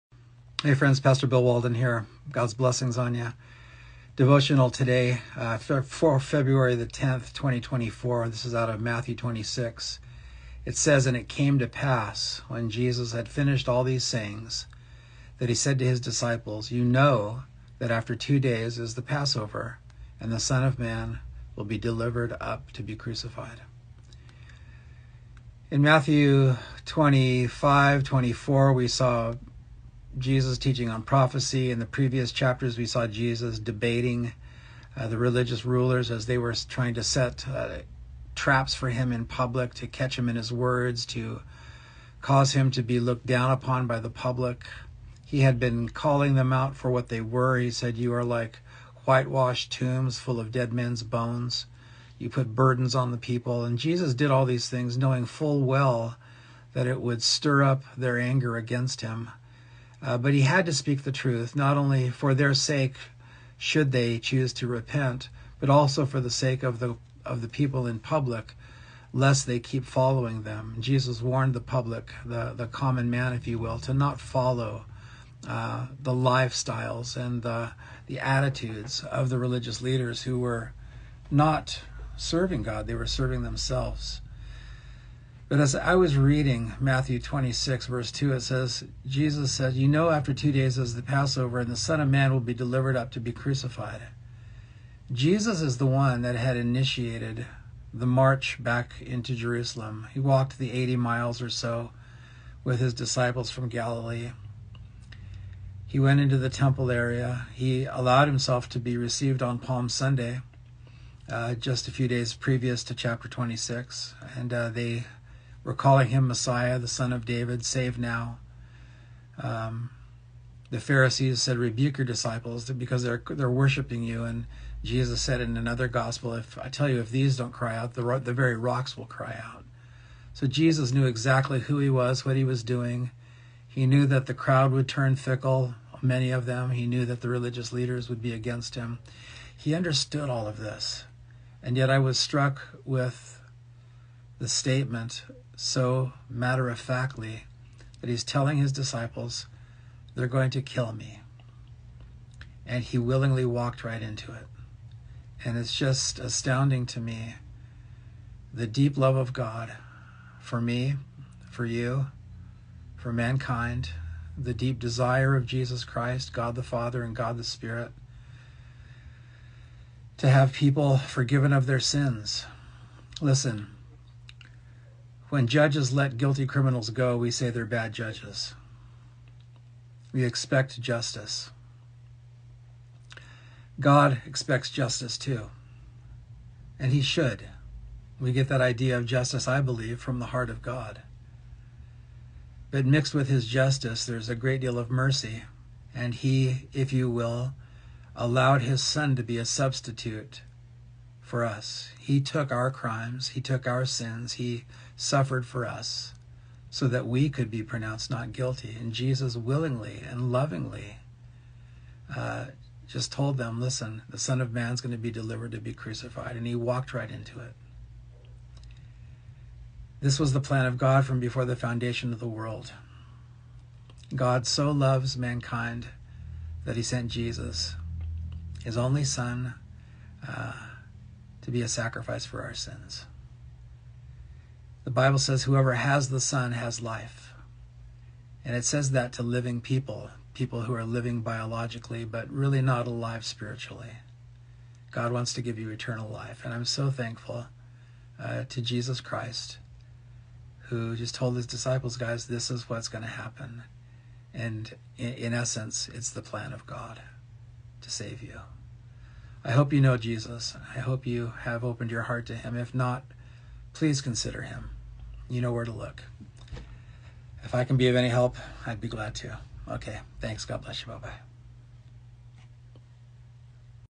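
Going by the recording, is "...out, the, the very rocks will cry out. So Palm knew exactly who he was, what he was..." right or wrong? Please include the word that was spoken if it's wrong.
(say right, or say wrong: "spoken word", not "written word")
wrong: "Jesus", not "Palm".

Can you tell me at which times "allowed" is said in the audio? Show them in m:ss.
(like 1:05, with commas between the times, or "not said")
1:47, 3:18.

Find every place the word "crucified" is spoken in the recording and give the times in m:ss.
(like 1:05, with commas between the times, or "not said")
0:22, 1:33, 3:35.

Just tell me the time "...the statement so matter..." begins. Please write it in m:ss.
2:24.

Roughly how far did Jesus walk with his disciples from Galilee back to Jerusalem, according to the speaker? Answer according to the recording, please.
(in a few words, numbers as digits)
80 miles.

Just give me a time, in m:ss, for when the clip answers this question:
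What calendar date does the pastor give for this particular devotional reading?
0:06.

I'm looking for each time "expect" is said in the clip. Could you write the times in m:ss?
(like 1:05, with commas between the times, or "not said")
3:00, 3:04.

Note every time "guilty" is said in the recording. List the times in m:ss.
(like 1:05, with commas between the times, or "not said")
2:56, 3:28.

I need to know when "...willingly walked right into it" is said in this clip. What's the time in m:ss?
2:32.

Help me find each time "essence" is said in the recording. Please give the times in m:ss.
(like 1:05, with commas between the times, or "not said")
4:15.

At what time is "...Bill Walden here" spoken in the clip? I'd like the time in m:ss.
0:01.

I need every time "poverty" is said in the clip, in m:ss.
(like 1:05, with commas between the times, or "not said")
not said.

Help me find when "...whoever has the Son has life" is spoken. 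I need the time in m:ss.
3:55.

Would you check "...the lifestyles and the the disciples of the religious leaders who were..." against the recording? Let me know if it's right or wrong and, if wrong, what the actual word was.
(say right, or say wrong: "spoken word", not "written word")
wrong: "attitudes", not "disciples".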